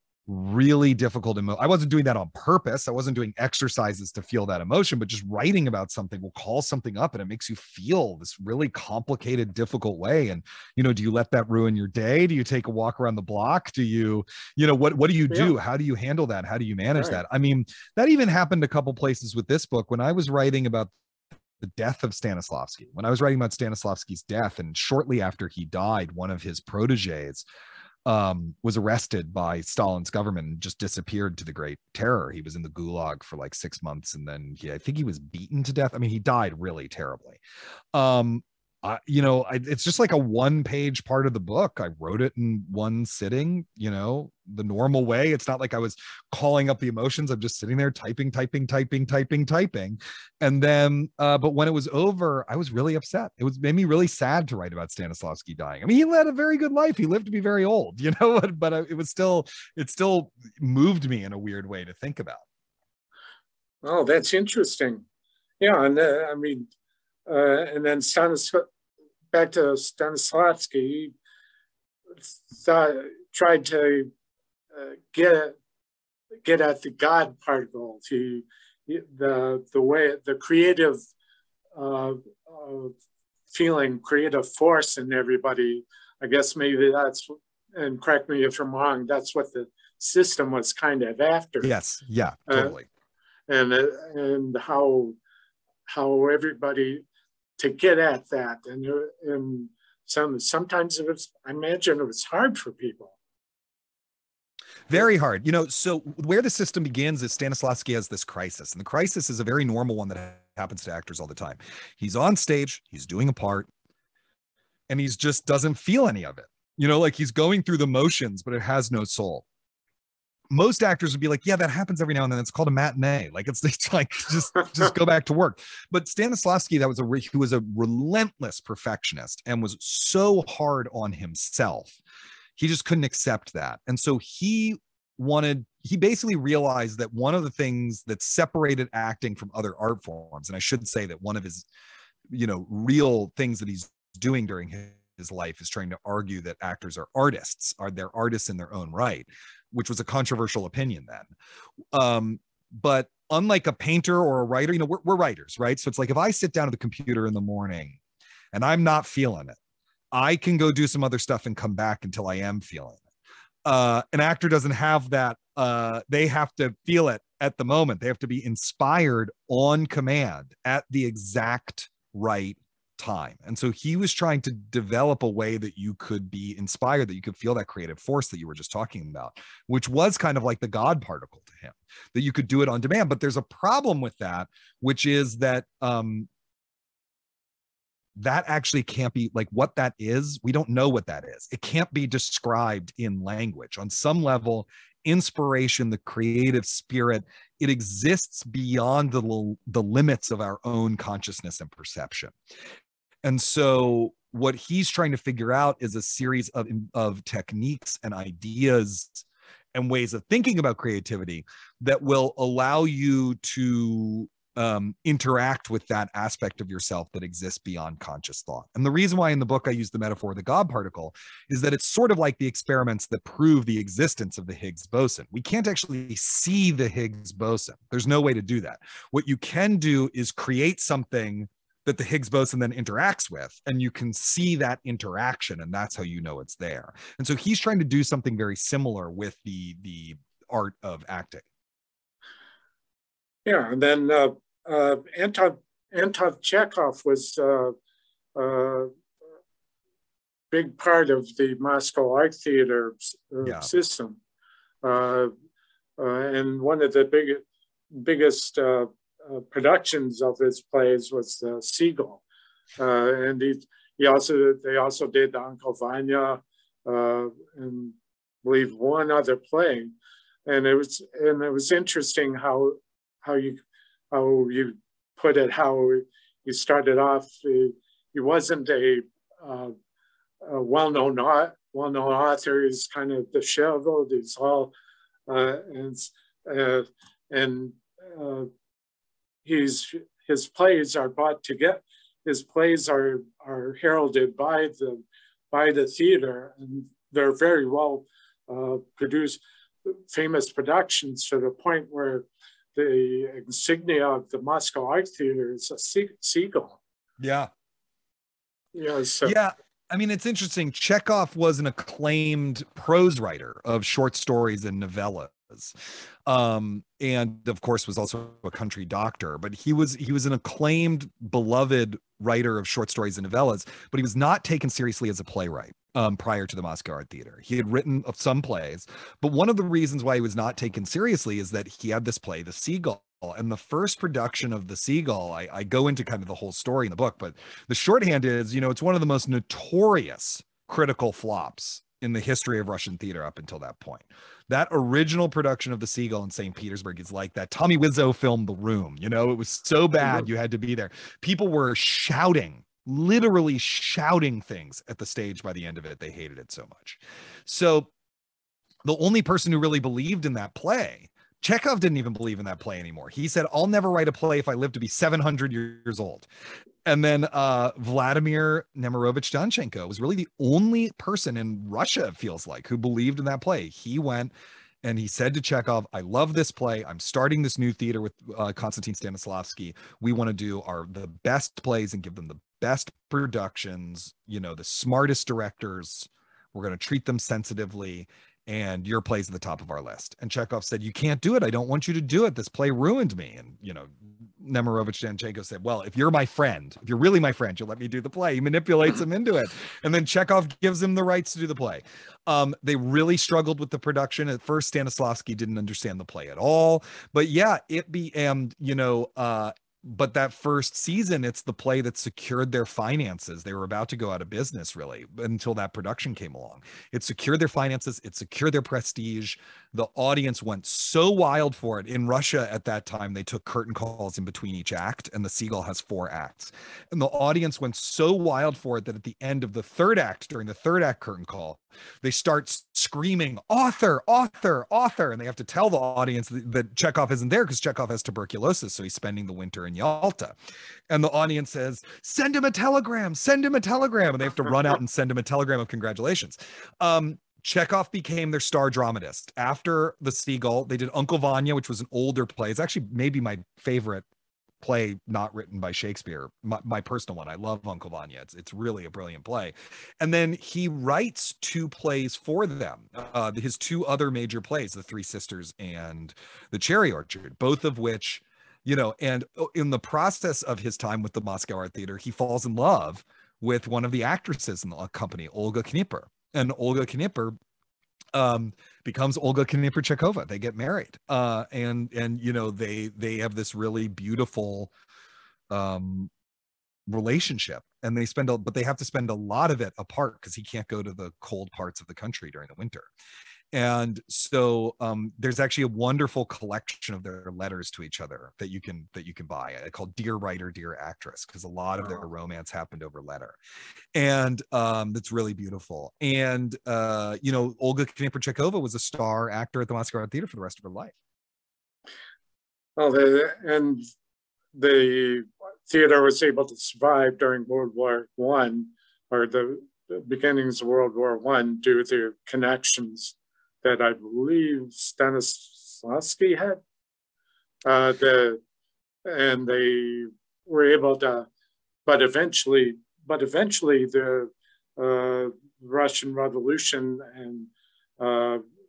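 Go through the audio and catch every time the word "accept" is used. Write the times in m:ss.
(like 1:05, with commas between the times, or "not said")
2:13.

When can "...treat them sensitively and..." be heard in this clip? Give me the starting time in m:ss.
6:26.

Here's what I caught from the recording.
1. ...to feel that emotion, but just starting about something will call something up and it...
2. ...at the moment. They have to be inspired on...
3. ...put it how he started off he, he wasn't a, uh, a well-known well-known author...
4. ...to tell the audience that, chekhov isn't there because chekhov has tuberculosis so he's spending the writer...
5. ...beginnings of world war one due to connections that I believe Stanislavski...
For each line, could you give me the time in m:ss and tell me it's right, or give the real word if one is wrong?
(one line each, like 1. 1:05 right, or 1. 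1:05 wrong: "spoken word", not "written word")
1. 0:04 wrong: "writing", not "starting"
2. 2:47 right
3. 4:35 right
4. 7:15 wrong: "winter", not "writer"
5. 8:40 right.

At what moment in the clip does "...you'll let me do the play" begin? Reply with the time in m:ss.
6:37.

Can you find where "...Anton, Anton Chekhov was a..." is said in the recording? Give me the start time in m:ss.
4:05.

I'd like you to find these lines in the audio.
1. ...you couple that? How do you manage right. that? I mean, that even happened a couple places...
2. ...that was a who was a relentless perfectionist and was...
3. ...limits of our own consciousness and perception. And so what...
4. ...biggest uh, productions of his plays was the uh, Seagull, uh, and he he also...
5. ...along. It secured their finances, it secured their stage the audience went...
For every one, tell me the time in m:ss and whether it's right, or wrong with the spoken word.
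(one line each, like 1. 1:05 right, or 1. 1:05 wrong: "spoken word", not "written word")
1. 0:15 wrong: "handle", not "couple"
2. 2:06 right
3. 3:19 right
4. 4:18 right
5. 6:56 wrong: "prestige", not "stage".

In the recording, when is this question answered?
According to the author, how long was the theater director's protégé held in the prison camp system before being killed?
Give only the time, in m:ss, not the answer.
0:33.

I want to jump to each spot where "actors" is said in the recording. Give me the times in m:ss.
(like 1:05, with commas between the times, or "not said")
1:50, 2:00, 2:26, 2:44, 8:29.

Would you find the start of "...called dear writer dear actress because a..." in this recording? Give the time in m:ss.
8:19.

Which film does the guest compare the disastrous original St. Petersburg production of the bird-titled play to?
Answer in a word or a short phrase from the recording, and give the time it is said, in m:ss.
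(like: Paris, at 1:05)
The Room, at 5:48.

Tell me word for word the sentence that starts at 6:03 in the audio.
He said, I'll never write a play if I live to be 700 years old.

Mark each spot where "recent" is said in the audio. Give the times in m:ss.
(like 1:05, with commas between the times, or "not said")
not said.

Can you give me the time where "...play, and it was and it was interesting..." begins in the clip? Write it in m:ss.
4:29.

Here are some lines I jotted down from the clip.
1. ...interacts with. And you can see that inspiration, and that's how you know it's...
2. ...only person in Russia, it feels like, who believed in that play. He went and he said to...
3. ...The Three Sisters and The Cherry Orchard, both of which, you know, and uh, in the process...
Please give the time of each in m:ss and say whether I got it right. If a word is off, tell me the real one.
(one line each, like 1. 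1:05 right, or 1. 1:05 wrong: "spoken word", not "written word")
1. 3:52 wrong: "interaction", not "inspiration"
2. 6:10 right
3. 7:44 right.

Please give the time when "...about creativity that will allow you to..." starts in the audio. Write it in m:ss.
3:30.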